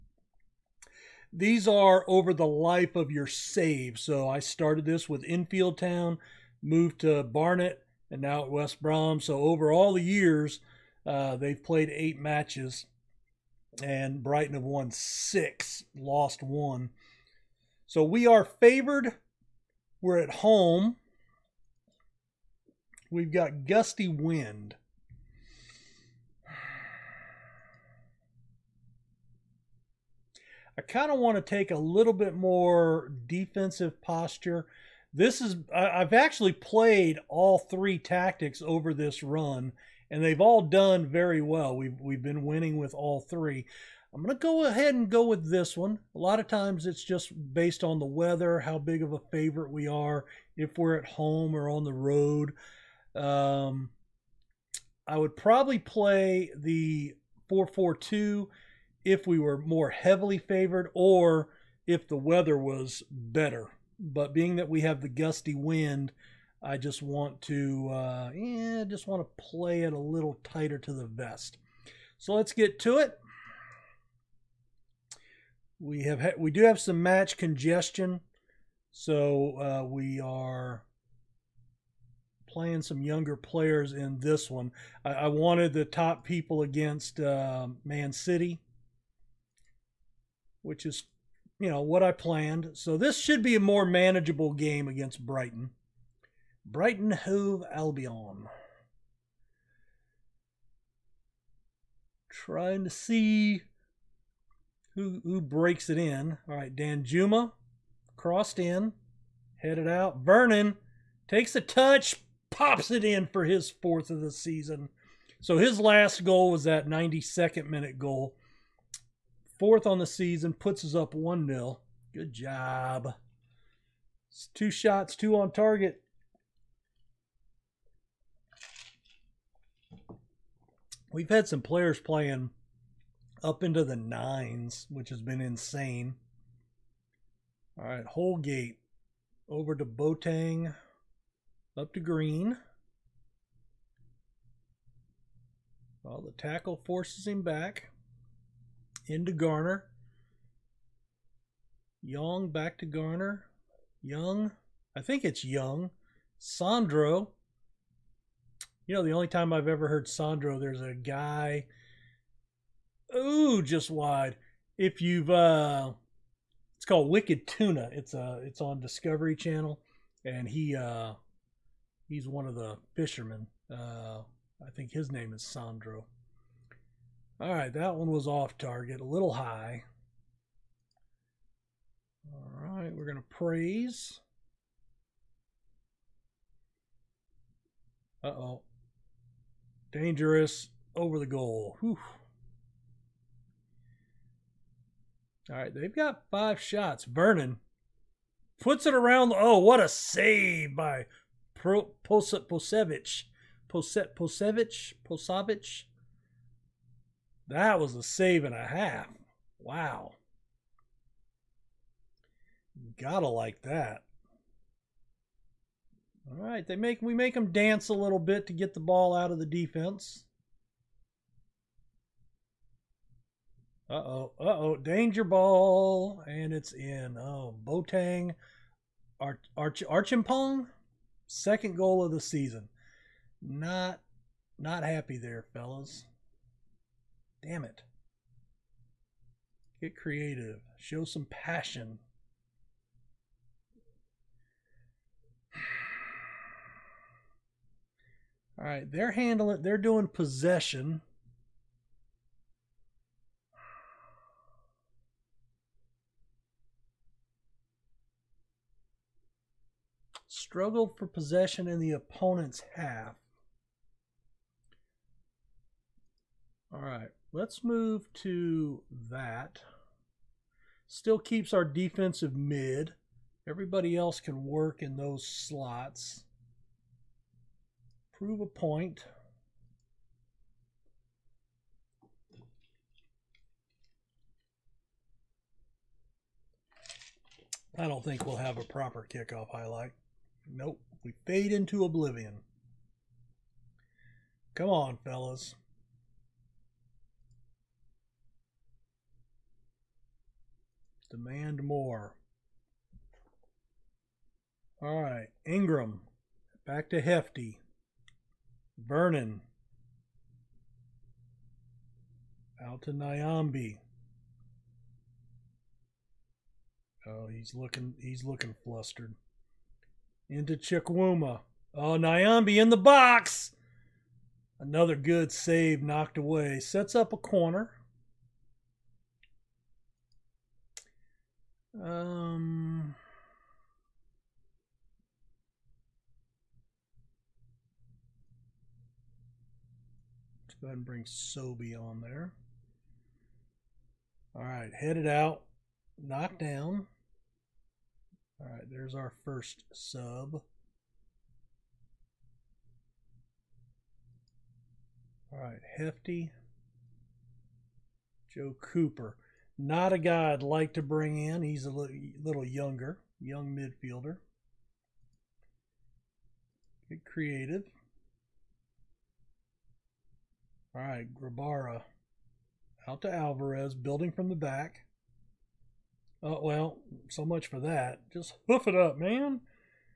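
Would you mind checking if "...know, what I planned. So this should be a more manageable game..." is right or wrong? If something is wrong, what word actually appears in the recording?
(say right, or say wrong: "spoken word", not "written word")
right.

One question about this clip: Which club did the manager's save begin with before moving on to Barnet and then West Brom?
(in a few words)
Enfield Town.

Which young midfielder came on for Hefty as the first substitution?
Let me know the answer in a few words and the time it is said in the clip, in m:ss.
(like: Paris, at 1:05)
Joe Cooper, at 5:58.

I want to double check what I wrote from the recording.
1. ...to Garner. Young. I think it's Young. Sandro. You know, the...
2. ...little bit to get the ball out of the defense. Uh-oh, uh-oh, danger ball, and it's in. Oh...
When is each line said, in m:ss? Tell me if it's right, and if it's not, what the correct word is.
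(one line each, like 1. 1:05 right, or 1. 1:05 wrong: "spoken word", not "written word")
1. 2:32 right
2. 3:37 right.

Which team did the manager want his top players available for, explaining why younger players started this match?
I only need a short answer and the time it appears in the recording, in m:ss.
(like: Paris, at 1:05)
Man City, at 1:27.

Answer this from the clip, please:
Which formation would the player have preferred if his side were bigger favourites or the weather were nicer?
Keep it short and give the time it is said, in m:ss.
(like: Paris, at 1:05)
4-4-2, at 0:57.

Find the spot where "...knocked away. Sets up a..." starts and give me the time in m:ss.
5:25.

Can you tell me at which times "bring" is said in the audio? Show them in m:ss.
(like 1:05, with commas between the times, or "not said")
5:40, 6:00.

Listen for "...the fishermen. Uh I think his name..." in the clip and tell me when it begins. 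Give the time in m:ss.
2:52.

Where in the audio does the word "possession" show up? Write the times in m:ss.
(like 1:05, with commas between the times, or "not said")
4:10, 4:21.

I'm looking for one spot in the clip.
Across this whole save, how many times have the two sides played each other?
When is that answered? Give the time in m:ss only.
0:11.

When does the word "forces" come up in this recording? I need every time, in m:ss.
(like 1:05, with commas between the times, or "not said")
2:26.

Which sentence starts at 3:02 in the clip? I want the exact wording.
All right, we're going to praise.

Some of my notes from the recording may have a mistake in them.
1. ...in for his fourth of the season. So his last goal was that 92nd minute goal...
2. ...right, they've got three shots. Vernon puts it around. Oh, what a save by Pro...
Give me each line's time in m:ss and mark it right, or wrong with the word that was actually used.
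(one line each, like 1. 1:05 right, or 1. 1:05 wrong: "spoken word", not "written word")
1. 1:53 right
2. 3:15 wrong: "five", not "three".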